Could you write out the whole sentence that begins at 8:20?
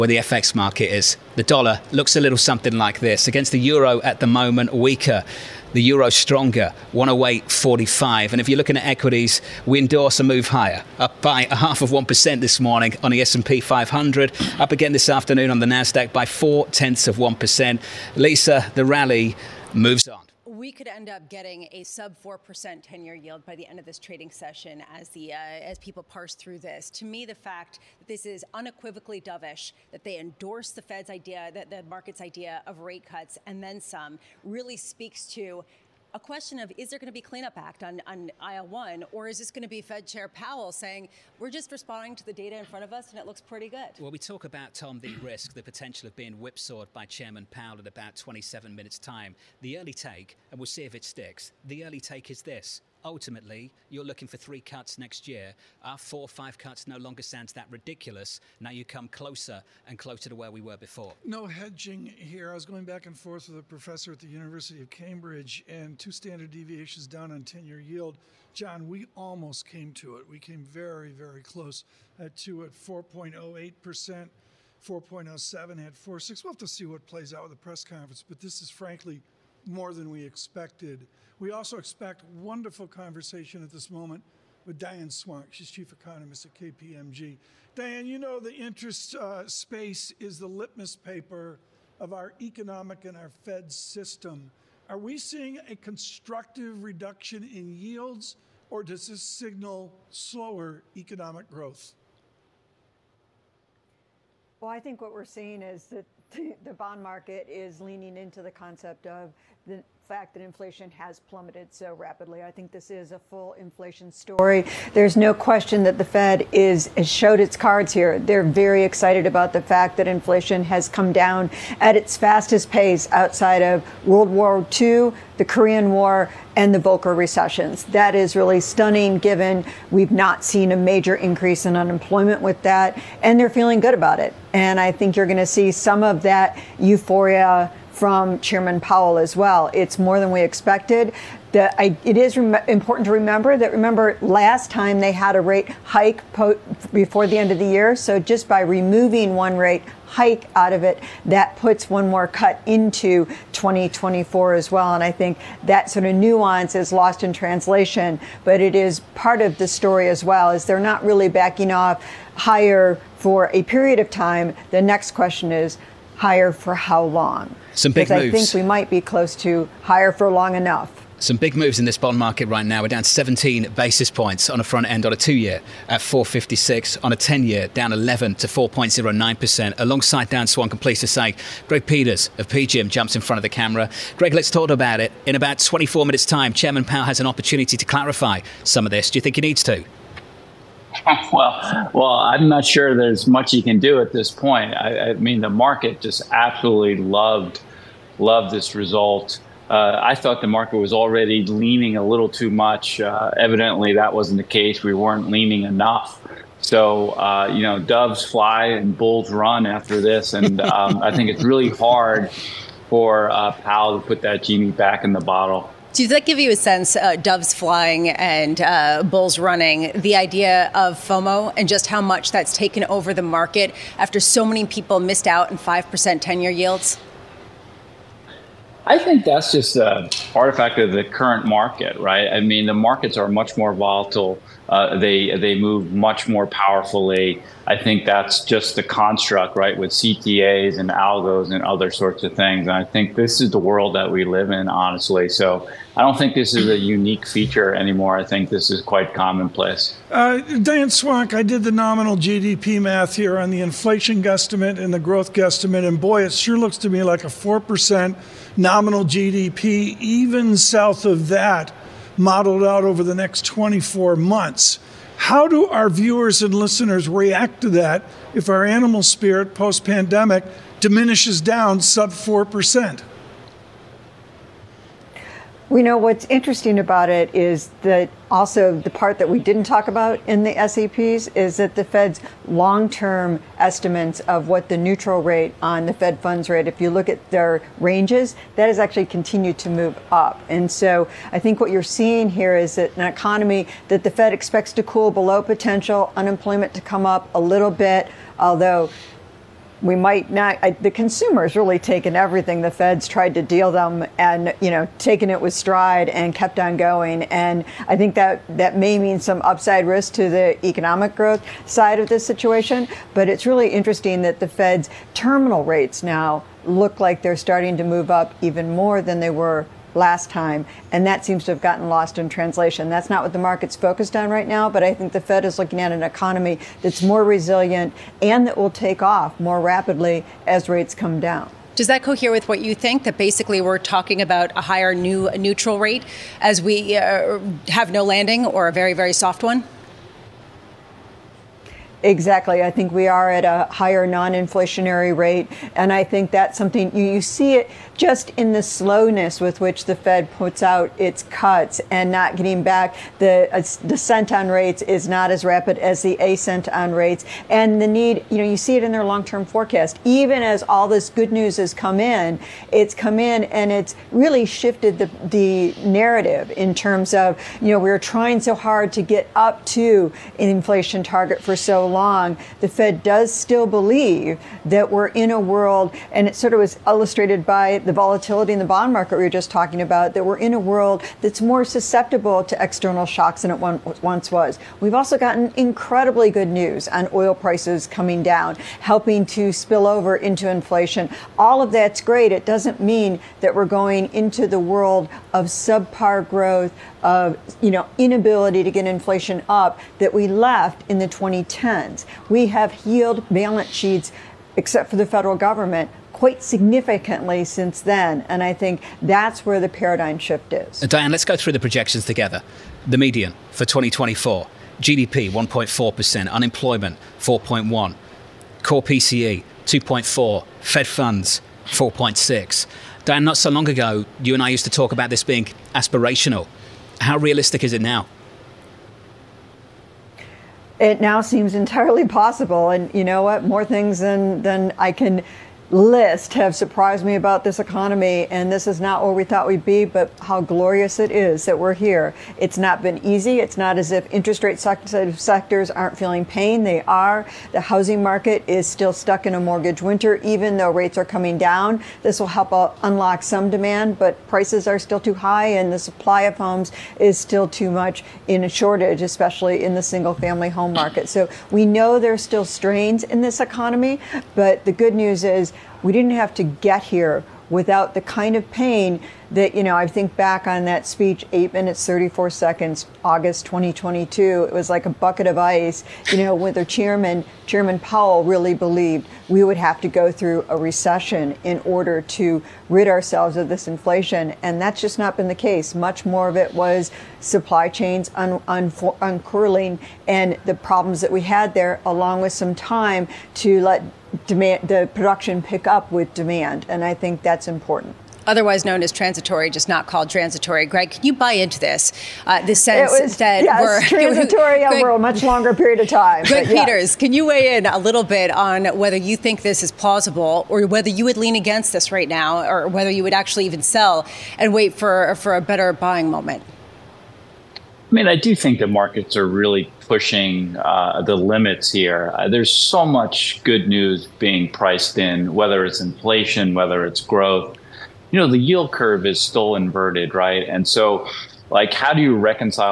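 Greg, can you buy into this?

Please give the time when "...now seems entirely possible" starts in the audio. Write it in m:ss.
7:10.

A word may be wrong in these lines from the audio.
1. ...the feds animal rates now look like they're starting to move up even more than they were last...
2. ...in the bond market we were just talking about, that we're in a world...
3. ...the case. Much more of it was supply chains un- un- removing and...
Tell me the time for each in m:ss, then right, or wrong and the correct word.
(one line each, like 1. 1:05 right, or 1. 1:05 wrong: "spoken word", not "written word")
1. 5:14 wrong: "terminal", not "animal"
2. 6:18 right
3. 8:05 wrong: "uncurling", not "removing".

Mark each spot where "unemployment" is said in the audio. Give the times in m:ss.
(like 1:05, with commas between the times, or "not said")
2:11, 4:56, 6:56.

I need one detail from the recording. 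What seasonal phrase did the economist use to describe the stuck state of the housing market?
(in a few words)
mortgage winter.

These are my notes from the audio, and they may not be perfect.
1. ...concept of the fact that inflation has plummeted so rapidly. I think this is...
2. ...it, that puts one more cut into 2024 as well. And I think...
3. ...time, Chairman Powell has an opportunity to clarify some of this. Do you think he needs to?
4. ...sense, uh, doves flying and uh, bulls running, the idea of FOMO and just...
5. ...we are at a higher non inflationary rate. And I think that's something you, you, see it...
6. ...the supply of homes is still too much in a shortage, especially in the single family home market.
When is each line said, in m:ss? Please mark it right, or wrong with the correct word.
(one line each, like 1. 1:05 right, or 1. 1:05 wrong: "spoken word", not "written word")
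1. 1:48 right
2. 2:30 right
3. 3:06 right
4. 3:36 right
5. 5:42 right
6. 7:35 right.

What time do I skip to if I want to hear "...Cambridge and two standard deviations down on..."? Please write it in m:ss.
1:04.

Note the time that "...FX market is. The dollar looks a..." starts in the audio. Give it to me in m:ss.
0:00.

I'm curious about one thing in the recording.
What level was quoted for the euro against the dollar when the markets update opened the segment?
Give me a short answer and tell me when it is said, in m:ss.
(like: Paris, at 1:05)
108.45, at 0:06.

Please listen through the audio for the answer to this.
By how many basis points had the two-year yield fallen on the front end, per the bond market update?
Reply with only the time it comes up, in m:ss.
2:53.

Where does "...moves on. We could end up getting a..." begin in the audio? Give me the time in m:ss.
0:19.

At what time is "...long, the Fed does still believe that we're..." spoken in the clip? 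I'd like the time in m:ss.
6:11.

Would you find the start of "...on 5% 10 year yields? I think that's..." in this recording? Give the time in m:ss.
3:45.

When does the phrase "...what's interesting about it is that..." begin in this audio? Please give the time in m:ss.
4:35.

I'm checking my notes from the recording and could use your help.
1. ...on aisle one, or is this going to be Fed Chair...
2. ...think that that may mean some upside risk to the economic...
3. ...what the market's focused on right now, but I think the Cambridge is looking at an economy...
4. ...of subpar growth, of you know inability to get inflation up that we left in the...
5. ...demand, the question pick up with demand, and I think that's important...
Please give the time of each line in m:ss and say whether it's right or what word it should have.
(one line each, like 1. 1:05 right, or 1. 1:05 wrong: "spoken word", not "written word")
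1. 0:38 right
2. 5:07 right
3. 5:23 wrong: "Fed", not "Cambridge"
4. 6:35 right
5. 8:14 wrong: "production", not "question".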